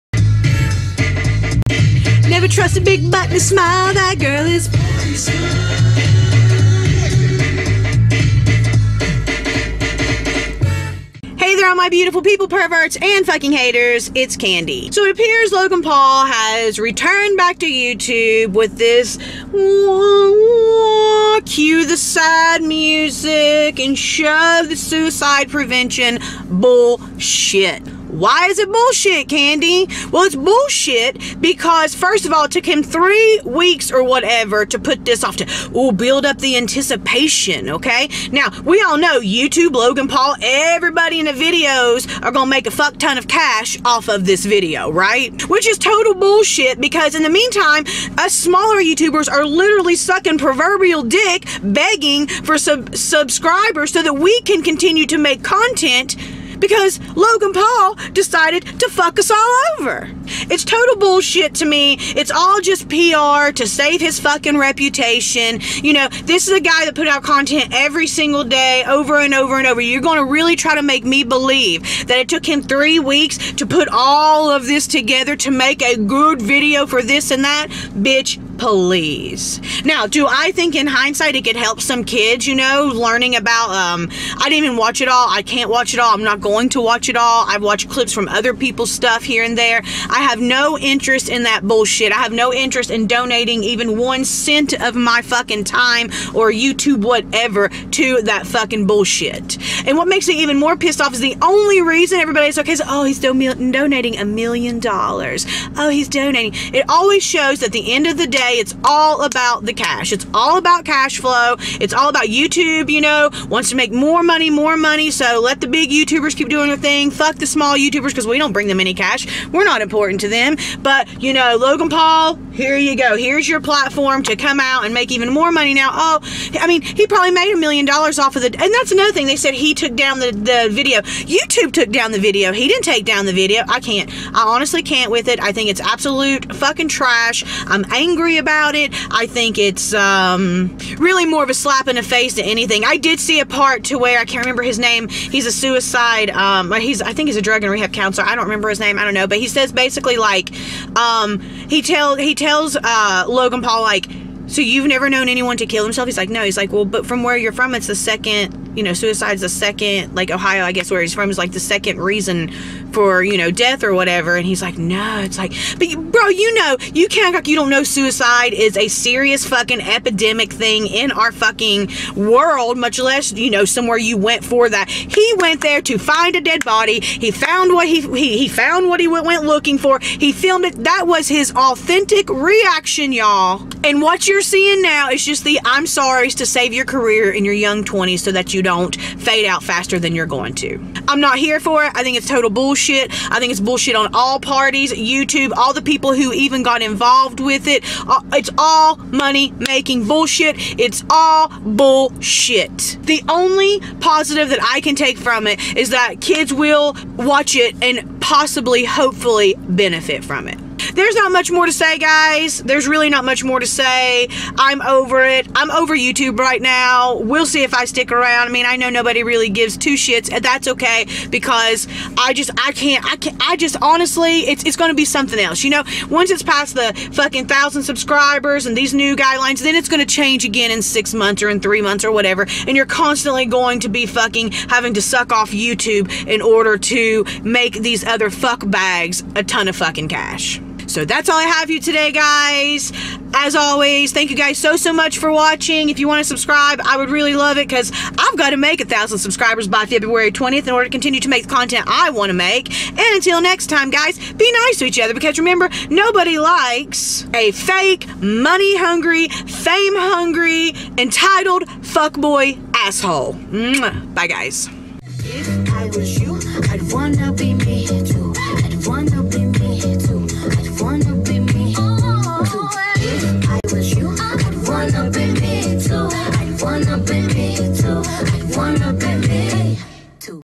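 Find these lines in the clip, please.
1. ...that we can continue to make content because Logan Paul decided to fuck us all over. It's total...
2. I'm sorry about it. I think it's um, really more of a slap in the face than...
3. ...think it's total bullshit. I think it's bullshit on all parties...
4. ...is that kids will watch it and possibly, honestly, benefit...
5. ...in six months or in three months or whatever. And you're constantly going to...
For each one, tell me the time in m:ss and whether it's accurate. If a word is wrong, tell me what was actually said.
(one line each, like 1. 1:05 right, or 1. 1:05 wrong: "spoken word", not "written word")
1. 0:54 right
2. 2:17 wrong: "angry", not "sorry"
3. 3:12 right
4. 3:25 wrong: "hopefully", not "honestly"
5. 3:50 right.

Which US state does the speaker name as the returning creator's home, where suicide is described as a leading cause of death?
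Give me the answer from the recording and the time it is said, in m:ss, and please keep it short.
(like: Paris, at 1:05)
Ohio, at 2:40.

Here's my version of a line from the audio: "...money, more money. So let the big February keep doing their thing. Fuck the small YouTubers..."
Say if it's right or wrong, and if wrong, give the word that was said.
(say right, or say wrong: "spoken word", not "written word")
wrong: "YouTubers", not "February".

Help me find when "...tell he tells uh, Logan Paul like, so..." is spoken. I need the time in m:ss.
2:31.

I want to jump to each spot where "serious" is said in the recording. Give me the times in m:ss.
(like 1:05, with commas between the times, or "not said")
2:48.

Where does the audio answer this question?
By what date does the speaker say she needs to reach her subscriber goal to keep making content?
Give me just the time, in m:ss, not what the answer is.
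4:09.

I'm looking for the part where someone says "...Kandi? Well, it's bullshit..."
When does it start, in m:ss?
0:29.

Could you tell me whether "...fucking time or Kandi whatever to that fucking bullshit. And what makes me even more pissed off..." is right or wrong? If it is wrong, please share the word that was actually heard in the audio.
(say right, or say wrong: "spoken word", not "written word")
wrong: "YouTube", not "Kandi".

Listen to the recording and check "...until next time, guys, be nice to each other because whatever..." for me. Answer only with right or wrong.
wrong.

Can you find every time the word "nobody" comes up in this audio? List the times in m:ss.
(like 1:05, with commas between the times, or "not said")
3:38, 4:15.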